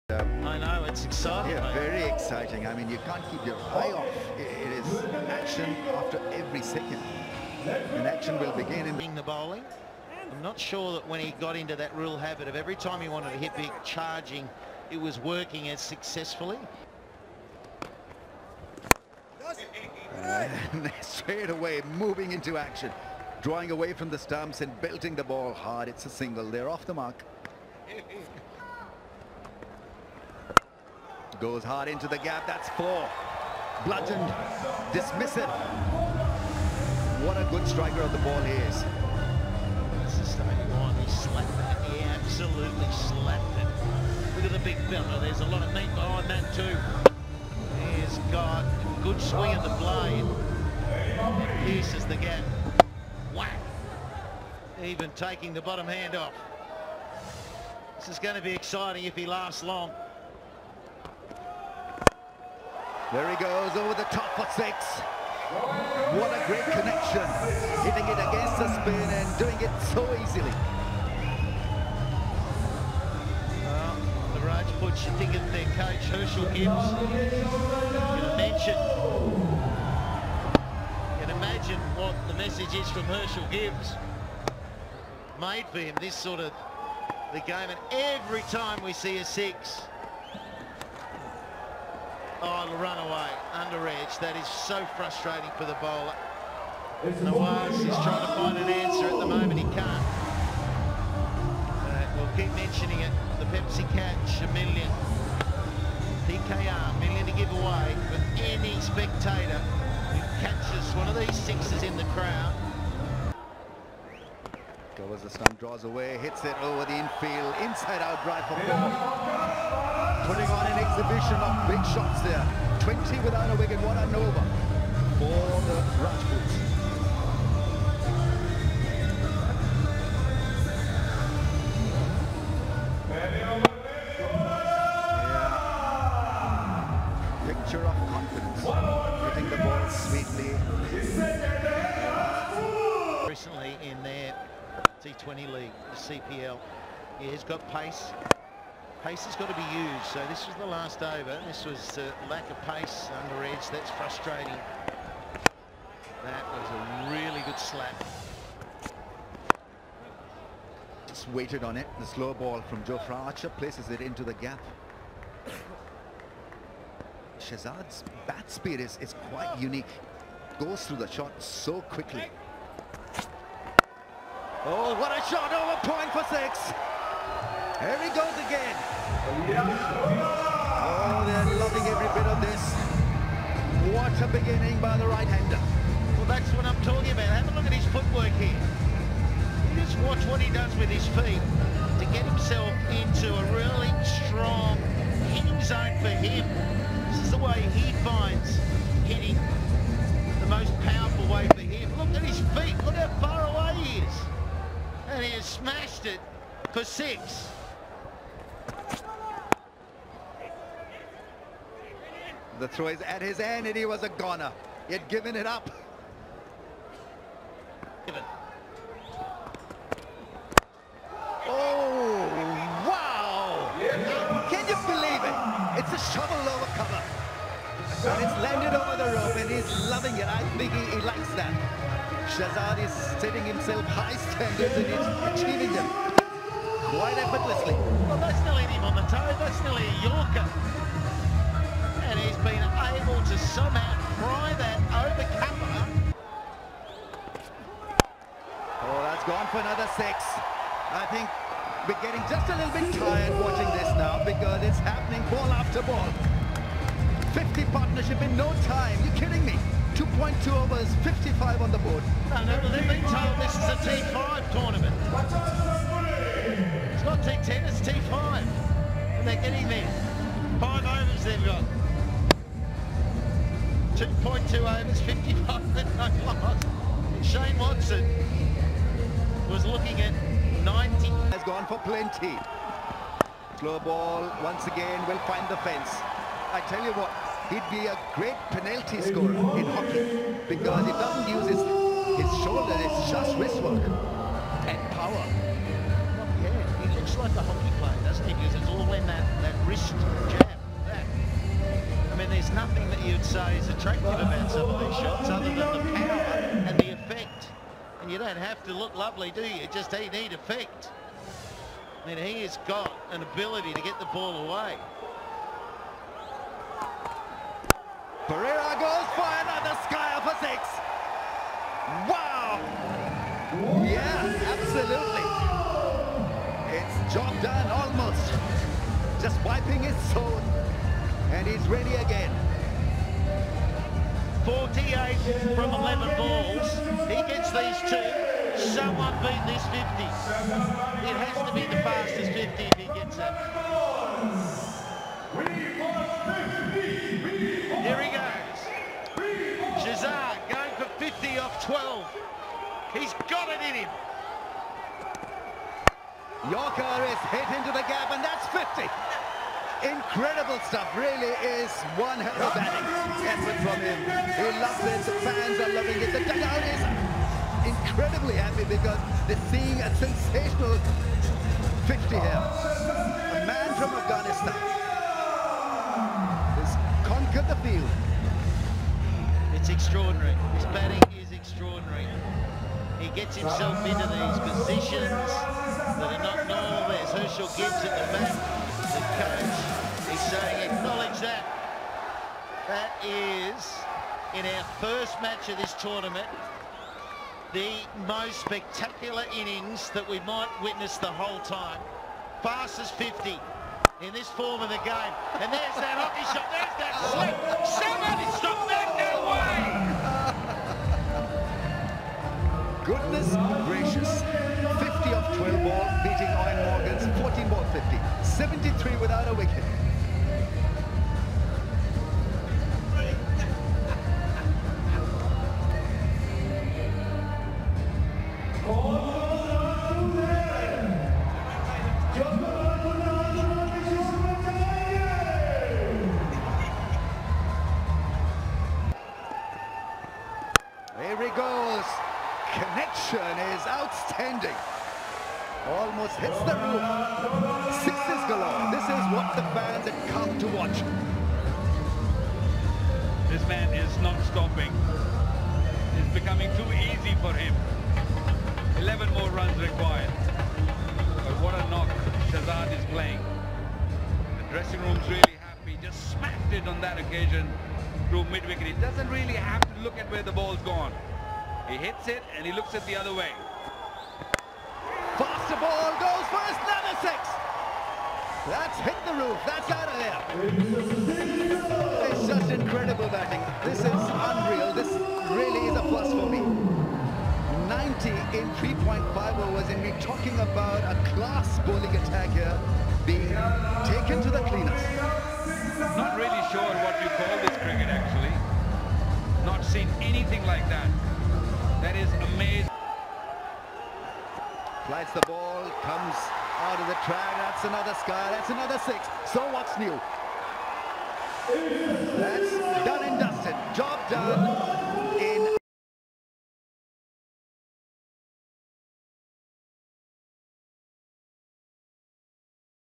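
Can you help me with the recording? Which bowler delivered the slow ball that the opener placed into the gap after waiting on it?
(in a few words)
Joe Archer.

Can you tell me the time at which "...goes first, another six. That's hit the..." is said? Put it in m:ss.
7:55.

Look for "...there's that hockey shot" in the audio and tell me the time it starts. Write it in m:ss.
6:45.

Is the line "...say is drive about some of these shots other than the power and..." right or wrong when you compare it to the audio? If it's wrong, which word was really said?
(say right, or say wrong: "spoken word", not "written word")
wrong: "attractive", not "drive".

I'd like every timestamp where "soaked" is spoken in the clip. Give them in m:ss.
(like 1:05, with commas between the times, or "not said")
not said.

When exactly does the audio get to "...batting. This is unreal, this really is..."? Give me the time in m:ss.
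8:03.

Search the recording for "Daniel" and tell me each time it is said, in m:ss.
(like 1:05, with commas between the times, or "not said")
not said.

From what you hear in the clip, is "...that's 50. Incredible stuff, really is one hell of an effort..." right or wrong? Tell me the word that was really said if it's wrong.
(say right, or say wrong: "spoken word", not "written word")
right.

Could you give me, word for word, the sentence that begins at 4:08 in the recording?
Oh, that's gone for another six.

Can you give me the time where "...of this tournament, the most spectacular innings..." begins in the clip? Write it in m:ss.
6:35.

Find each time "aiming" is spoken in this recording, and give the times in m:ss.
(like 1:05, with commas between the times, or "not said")
not said.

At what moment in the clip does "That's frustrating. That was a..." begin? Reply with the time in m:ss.
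2:33.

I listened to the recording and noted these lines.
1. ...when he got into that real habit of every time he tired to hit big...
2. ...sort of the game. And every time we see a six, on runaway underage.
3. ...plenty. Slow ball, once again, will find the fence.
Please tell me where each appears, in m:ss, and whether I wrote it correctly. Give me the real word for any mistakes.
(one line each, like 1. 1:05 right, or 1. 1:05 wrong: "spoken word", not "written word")
1. 0:11 wrong: "wanted", not "tired"
2. 1:26 right
3. 4:41 right.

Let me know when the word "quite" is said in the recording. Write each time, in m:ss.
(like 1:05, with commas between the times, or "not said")
2:49, 3:56.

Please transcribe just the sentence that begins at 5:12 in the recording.
I mean, he has got an ability to get the ball away.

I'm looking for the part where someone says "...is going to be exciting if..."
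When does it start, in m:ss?
0:58.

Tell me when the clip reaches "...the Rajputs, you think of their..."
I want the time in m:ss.
1:14.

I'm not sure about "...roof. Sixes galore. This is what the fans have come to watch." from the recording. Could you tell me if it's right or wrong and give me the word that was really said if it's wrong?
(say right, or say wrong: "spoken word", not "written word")
right.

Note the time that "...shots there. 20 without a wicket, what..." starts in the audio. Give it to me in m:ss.
2:01.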